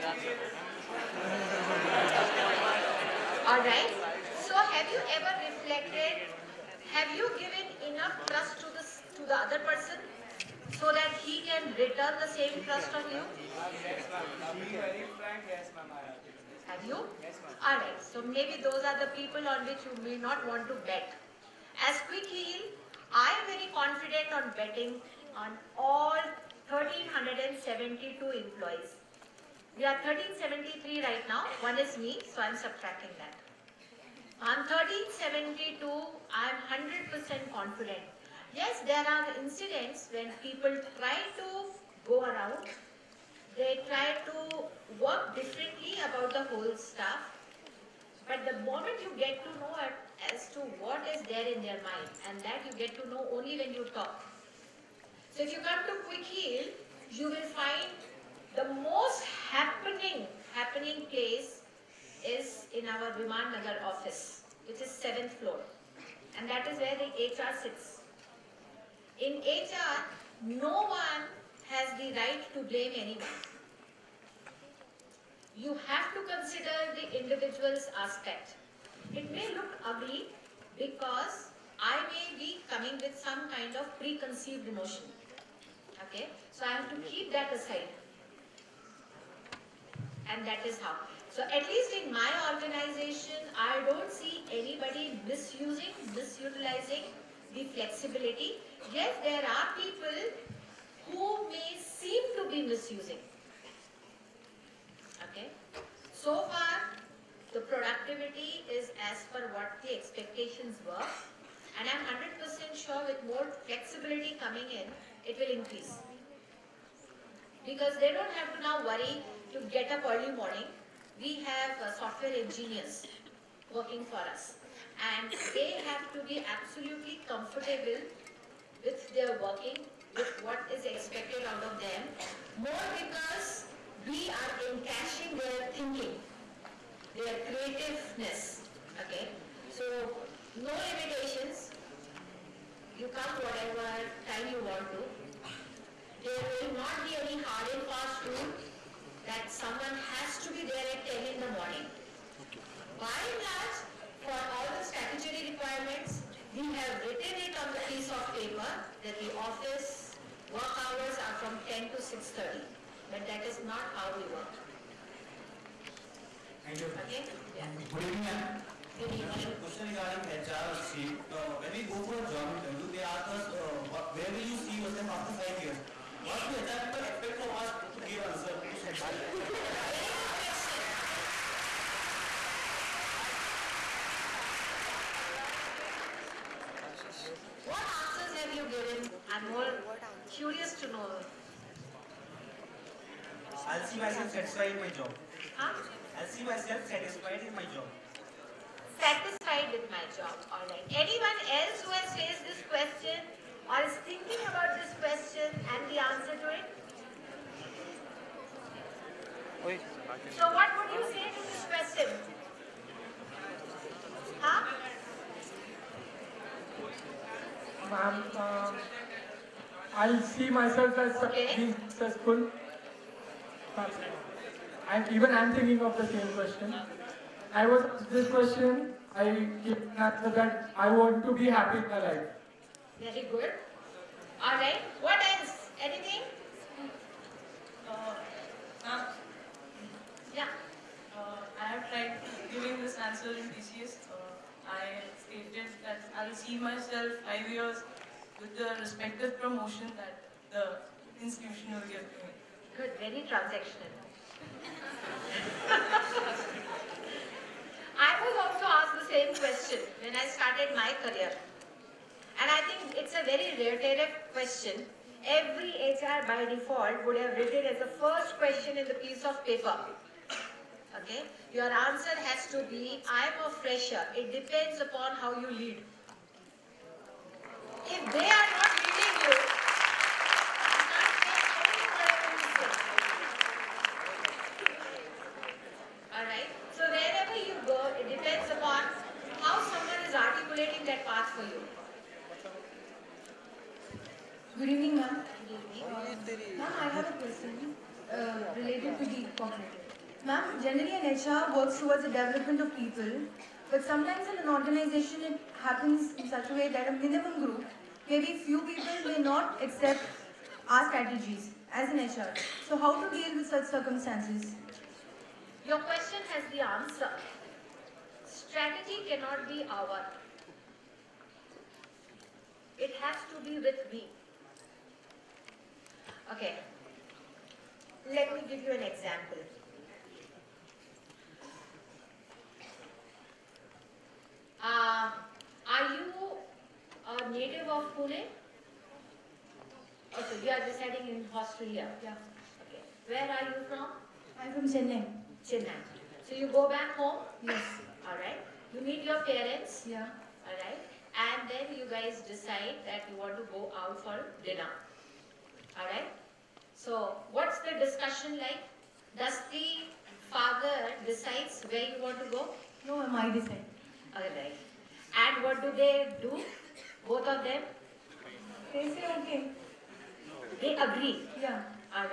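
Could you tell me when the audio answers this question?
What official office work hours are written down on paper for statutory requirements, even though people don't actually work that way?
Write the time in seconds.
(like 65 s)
161 s.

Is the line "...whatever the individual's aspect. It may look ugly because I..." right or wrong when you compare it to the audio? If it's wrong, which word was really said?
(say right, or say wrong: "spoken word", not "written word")
wrong: "consider", not "whatever".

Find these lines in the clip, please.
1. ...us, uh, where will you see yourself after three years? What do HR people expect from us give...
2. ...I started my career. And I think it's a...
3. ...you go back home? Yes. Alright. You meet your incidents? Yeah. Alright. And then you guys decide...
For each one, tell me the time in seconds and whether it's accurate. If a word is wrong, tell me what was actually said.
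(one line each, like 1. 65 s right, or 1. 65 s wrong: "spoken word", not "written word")
1. 173 s wrong: "five", not "three"
2. 260 s right
3. 346 s wrong: "parents", not "incidents".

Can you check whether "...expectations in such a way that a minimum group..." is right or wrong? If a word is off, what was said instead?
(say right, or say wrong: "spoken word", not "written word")
wrong: "happens", not "expectations".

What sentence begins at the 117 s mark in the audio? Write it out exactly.
Because they don't have to now worry to get up early morning we have uh, software engineers working for us.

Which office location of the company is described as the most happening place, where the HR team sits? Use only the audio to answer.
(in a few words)
Viman Nagar.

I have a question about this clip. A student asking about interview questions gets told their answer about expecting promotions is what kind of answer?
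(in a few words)
Transactional.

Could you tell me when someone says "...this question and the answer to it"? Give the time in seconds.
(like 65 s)
204 s.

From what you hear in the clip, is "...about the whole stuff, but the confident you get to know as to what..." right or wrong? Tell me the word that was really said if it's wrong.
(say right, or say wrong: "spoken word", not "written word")
wrong: "moment", not "confident".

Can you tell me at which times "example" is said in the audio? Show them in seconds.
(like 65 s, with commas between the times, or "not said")
328 s.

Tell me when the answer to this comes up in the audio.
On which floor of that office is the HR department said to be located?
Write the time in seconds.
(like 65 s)
64 s.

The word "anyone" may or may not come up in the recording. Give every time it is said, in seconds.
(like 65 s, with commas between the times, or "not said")
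72 s, 200 s.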